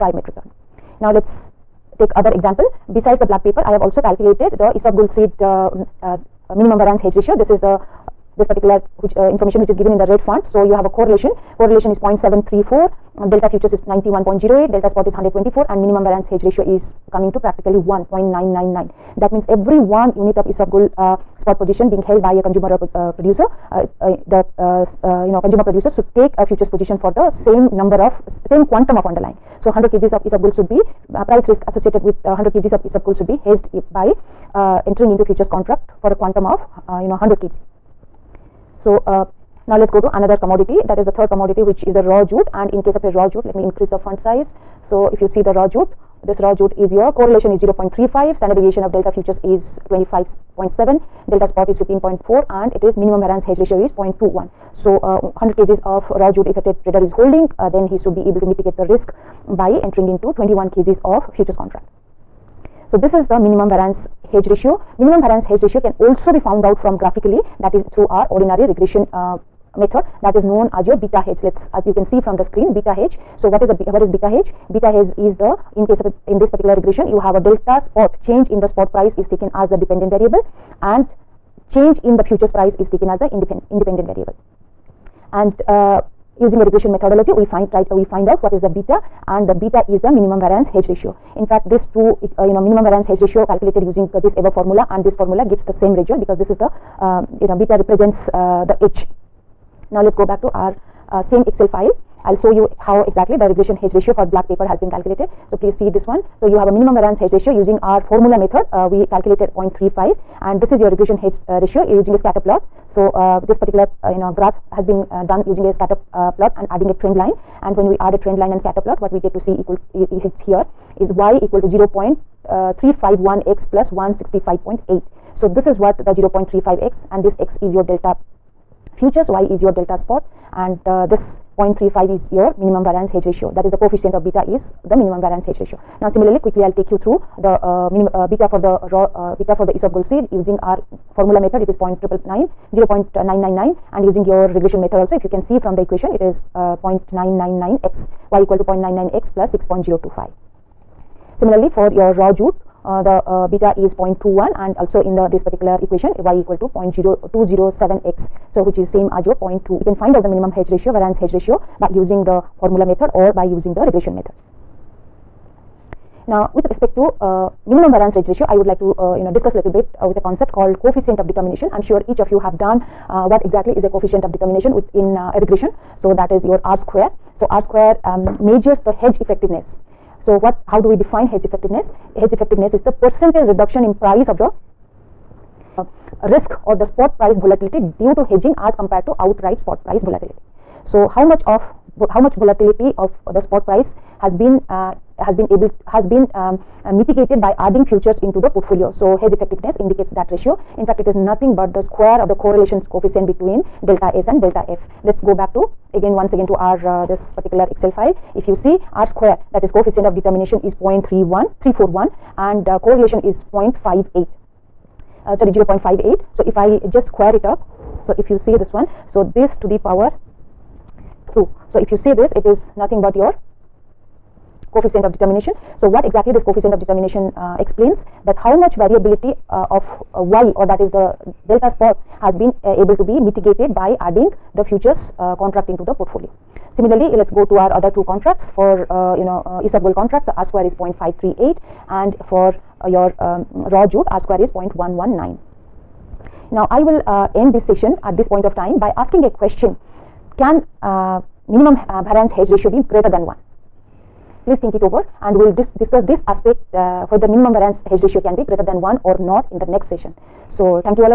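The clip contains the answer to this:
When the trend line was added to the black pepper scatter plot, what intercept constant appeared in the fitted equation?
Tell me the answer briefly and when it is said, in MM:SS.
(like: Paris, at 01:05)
165.8, at 02:03.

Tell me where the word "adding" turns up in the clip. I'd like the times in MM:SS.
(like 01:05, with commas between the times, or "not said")
01:56, 03:17, 03:54.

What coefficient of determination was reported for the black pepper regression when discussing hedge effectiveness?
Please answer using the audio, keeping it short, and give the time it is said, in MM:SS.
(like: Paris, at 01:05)
0.31341, at 03:30.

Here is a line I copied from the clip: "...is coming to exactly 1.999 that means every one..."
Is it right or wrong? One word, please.
wrong.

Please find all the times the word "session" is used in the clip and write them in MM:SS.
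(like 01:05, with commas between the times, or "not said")
04:07, 04:19.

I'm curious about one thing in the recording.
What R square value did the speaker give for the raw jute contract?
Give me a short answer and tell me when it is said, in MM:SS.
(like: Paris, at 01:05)
0.119, at 04:04.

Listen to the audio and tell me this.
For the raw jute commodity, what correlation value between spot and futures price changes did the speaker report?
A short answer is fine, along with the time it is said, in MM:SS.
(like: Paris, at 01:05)
0.35, at 00:47.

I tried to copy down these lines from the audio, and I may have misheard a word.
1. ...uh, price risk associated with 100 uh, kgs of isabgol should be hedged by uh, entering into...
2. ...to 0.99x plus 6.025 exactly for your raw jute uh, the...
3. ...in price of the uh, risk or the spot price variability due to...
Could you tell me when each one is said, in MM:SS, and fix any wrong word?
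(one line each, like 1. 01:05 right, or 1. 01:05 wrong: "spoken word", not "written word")
1. 00:31 right
2. 02:28 wrong: "similarly", not "exactly"
3. 03:03 wrong: "volatility", not "variability".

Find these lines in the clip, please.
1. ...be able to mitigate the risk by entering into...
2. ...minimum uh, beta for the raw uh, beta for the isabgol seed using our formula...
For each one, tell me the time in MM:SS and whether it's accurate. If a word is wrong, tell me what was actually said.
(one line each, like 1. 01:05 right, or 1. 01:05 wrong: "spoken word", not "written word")
1. 00:58 right
2. 02:17 right.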